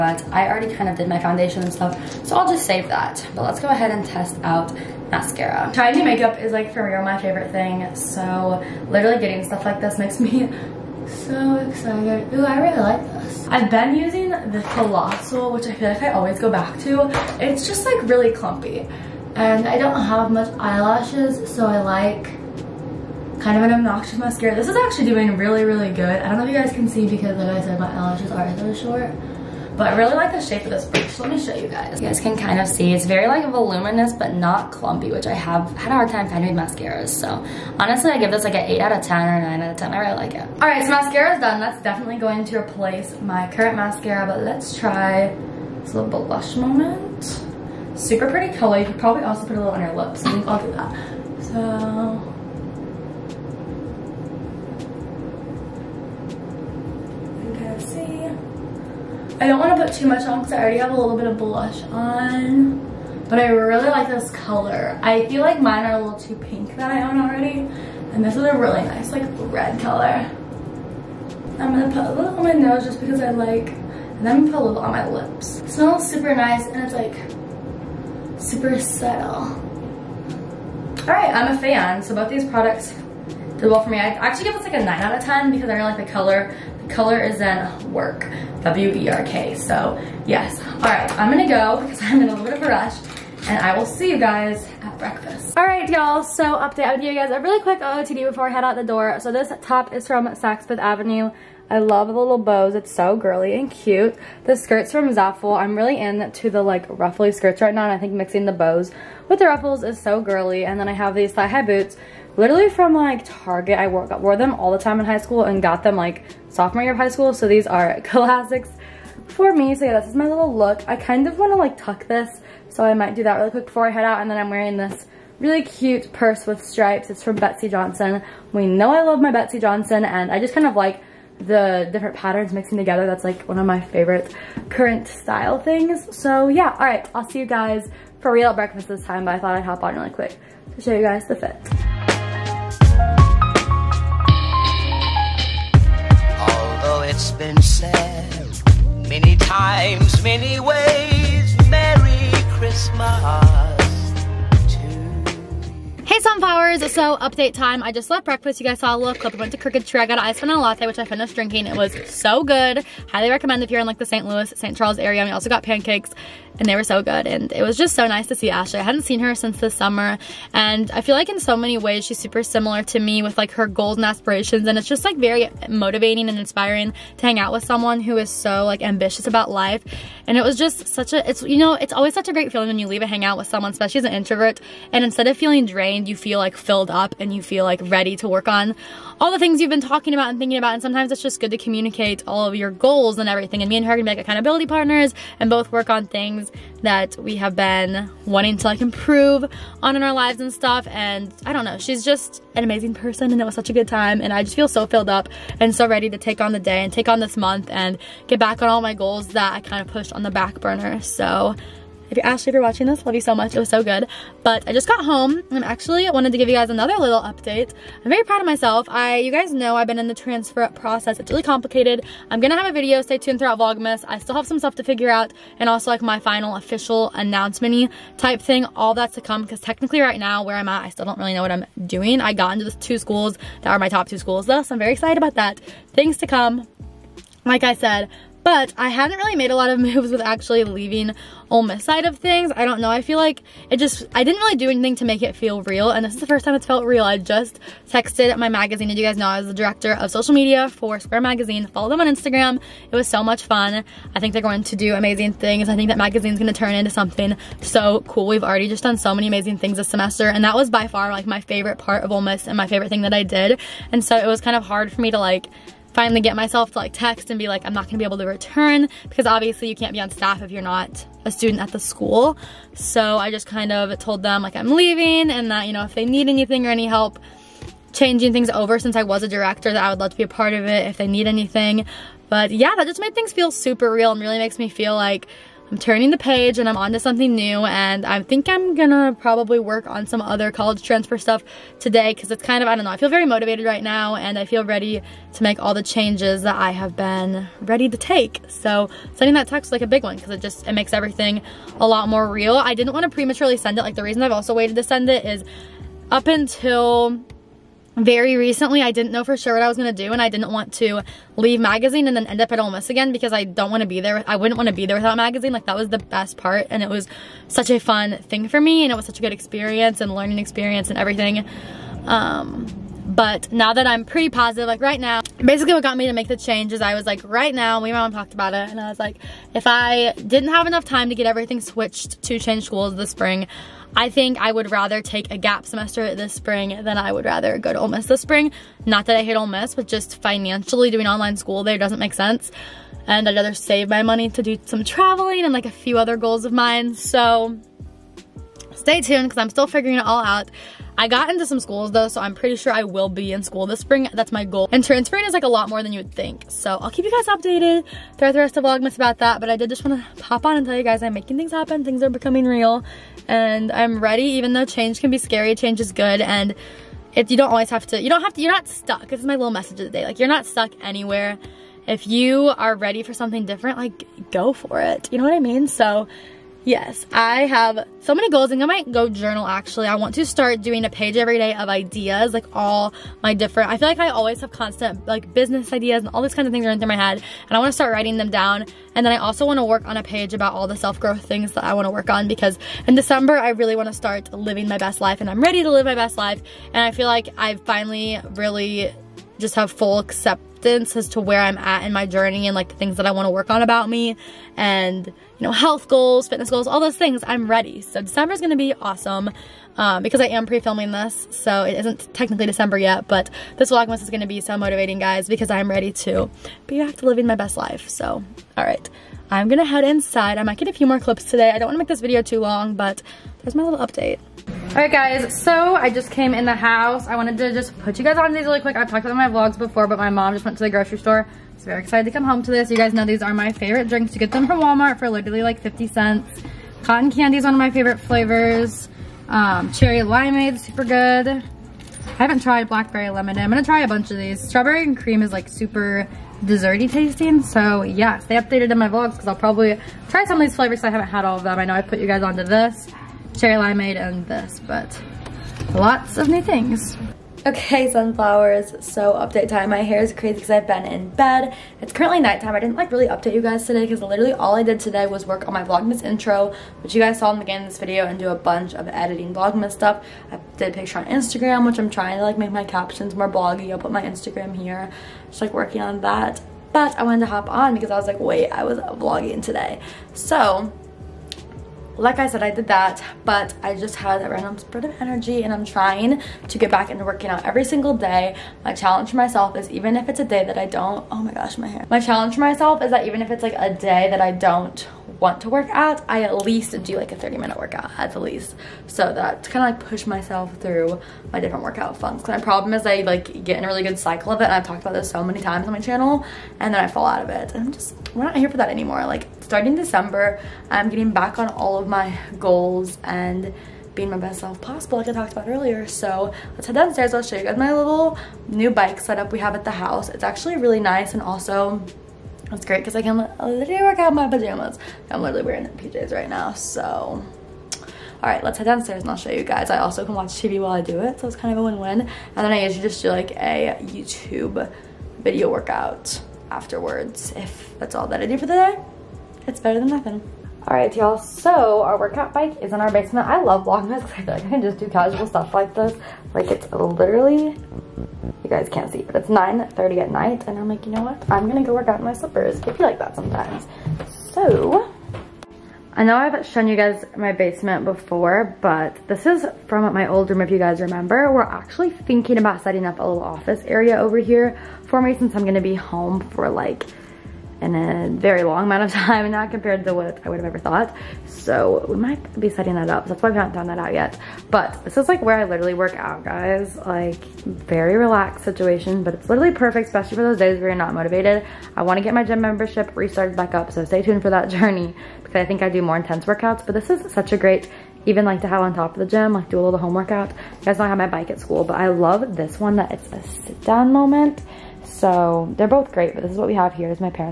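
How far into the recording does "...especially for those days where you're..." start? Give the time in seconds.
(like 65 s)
579 s.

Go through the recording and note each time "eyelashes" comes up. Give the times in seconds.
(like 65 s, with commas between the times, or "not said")
20 s, 27 s.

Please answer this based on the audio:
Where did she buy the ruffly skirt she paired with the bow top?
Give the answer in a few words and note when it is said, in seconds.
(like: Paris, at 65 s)
Zaful, at 105 s.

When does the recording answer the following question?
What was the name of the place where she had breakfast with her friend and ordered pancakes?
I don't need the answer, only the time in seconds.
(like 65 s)
159 s.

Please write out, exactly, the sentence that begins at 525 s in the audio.
I'm literally wearing the PJs right now.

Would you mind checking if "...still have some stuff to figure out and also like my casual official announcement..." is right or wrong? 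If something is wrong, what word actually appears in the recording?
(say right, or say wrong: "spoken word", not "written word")
wrong: "final", not "casual".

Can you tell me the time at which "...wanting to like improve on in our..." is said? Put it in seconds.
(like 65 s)
198 s.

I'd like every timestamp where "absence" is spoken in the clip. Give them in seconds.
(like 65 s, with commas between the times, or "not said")
not said.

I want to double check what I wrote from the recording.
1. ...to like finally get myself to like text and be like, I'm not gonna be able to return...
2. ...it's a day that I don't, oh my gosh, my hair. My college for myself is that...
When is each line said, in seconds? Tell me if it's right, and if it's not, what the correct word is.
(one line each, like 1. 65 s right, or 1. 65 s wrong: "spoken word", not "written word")
1. 265 s right
2. 490 s wrong: "challenge", not "college".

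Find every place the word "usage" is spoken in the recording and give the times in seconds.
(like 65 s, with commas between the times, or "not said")
not said.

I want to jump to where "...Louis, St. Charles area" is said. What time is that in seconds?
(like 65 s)
164 s.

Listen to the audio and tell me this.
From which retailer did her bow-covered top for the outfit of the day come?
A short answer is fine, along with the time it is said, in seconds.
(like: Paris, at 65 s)
Saks Fifth Avenue, at 100 s.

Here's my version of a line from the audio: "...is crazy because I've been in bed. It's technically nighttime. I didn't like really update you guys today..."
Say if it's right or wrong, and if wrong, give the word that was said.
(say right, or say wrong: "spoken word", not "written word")
wrong: "currently", not "technically".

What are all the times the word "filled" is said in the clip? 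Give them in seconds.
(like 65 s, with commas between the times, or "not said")
186 s, 204 s.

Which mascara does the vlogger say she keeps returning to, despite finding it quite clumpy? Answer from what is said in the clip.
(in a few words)
Colossal.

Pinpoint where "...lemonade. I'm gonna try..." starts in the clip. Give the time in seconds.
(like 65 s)
443 s.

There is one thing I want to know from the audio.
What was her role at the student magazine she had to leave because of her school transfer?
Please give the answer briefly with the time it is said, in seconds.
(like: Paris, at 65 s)
director of social media, at 249 s.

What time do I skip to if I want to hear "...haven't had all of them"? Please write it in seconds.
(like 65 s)
450 s.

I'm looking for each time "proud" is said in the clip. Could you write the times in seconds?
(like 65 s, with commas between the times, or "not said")
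218 s.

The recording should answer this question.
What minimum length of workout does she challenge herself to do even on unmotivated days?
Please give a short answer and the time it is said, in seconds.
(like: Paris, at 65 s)
30 minutes, at 497 s.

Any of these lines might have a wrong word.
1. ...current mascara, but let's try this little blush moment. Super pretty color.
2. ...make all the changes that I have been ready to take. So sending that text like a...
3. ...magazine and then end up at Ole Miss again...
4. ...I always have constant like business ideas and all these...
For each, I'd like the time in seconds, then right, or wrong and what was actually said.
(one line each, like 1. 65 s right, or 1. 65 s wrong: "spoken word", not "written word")
1. 43 s right
2. 295 s right
3. 311 s right
4. 384 s right.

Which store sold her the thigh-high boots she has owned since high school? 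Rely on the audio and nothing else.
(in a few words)
Target.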